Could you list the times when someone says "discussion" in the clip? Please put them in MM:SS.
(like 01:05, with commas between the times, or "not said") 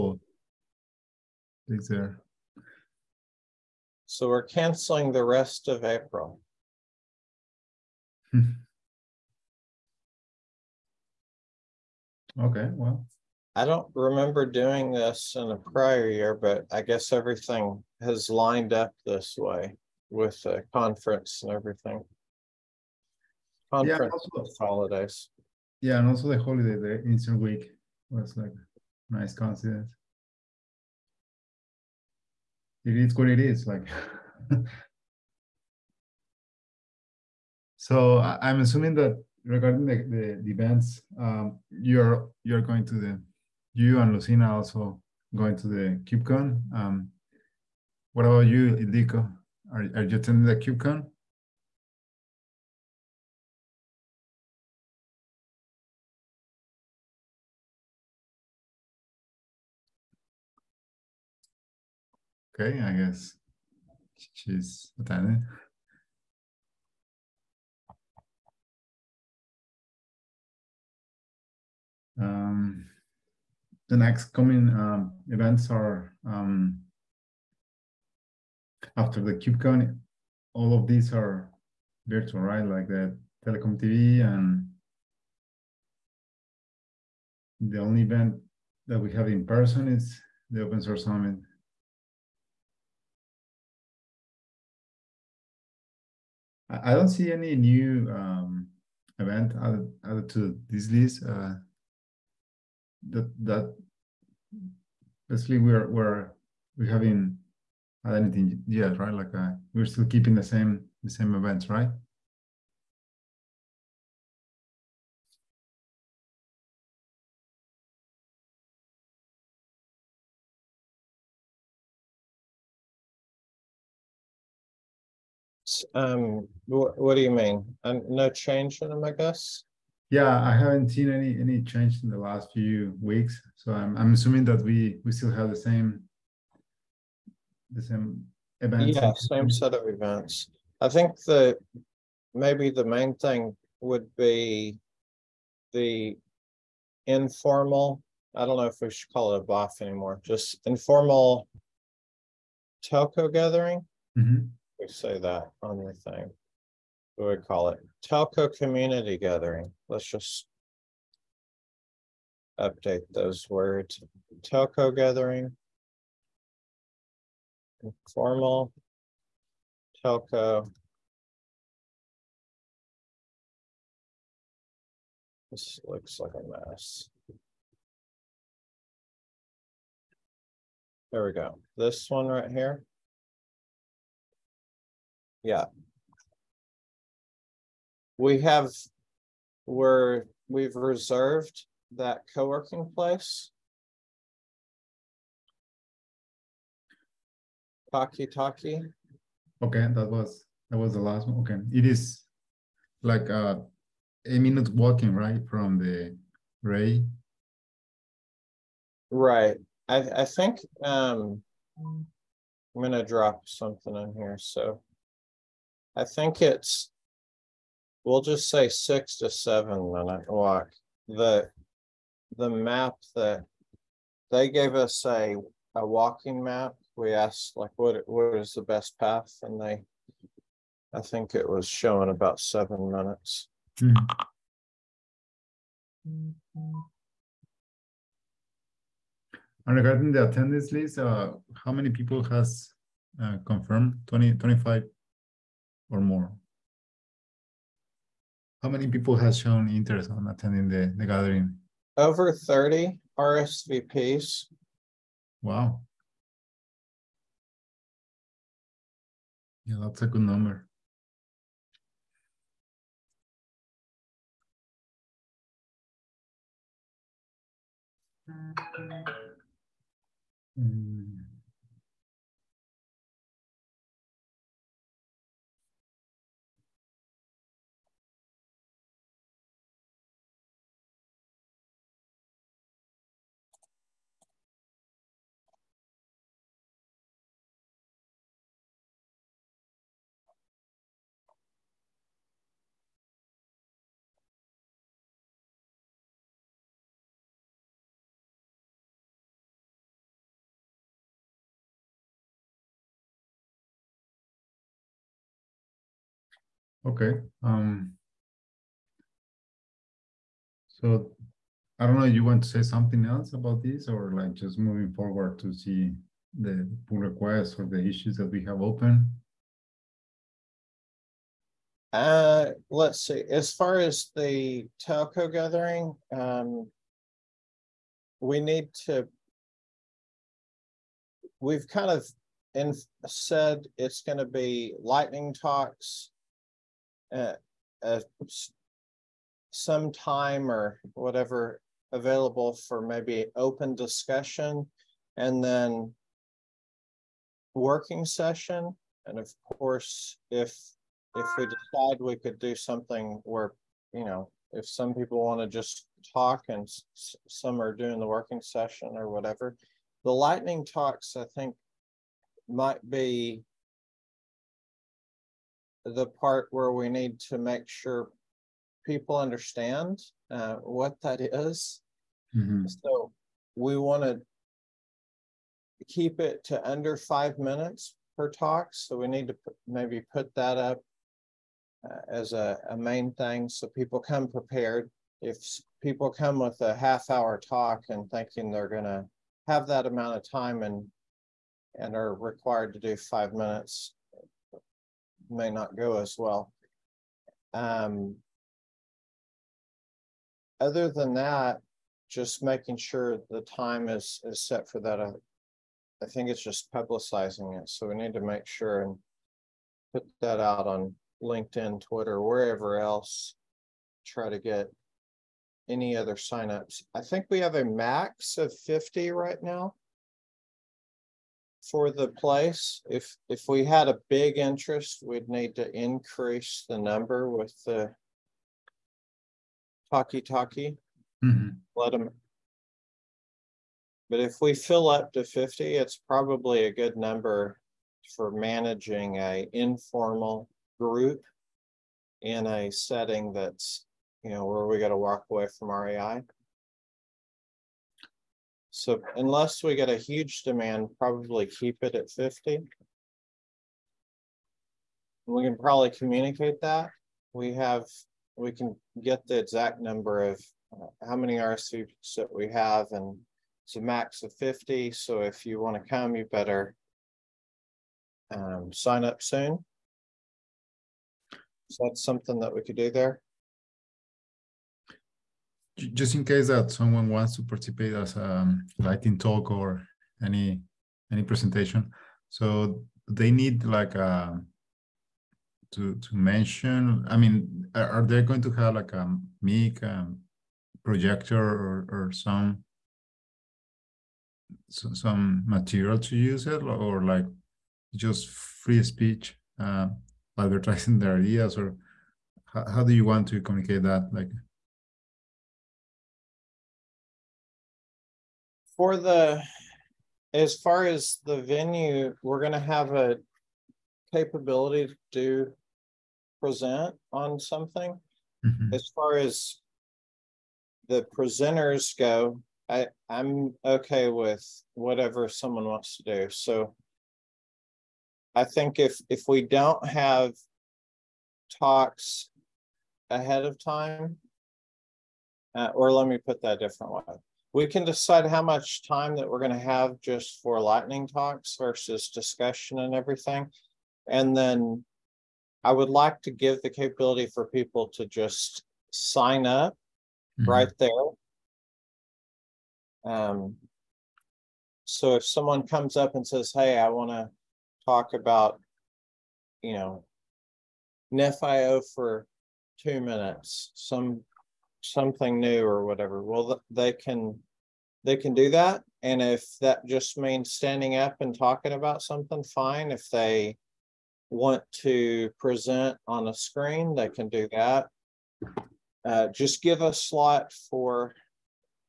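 05:43, 09:02.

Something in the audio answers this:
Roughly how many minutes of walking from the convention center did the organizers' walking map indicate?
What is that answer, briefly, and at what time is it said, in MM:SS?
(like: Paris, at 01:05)
7, at 03:52.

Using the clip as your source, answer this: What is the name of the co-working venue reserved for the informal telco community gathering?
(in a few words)
Talkie talkie.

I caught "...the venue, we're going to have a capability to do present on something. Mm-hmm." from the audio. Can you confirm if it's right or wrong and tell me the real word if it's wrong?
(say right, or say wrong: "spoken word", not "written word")
right.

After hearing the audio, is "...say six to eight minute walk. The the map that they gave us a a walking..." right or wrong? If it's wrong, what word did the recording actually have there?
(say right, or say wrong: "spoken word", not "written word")
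wrong: "seven", not "eight".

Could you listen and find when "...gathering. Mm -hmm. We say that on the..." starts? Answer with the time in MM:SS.
02:33.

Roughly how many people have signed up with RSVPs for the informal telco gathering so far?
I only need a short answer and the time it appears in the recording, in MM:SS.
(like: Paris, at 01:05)
Over 30, at 04:11.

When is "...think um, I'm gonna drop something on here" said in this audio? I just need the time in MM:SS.
03:30.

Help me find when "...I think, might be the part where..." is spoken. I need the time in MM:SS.
06:01.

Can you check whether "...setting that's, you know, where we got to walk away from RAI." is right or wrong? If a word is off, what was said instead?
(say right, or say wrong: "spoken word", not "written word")
right.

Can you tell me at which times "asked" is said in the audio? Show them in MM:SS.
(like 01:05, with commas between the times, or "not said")
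03:47.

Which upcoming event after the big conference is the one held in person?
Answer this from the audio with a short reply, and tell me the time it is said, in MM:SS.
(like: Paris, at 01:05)
Open Source Summit, at 01:30.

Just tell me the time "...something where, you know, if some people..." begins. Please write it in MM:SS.
05:52.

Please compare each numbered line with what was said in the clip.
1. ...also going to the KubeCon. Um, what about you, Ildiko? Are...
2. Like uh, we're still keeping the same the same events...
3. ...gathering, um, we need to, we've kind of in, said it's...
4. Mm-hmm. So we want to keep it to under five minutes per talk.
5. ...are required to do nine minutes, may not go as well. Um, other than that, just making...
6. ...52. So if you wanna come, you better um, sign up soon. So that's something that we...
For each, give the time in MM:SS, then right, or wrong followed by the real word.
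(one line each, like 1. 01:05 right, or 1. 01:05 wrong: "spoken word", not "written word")
1. 00:44 right
2. 01:49 right
3. 05:25 right
4. 06:12 right
5. 06:31 wrong: "five", not "nine"
6. 07:44 wrong: "50", not "52".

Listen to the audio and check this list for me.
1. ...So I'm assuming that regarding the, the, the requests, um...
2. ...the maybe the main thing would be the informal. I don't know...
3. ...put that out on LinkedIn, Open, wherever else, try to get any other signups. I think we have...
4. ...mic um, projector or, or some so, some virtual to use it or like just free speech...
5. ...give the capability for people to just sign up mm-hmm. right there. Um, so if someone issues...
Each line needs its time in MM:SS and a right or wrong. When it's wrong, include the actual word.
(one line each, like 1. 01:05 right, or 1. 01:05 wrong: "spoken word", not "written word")
1. 00:37 wrong: "events", not "requests"
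2. 02:21 right
3. 06:49 wrong: "Twitter", not "Open"
4. 08:09 wrong: "material", not "virtual"
5. 09:06 wrong: "comes", not "issues".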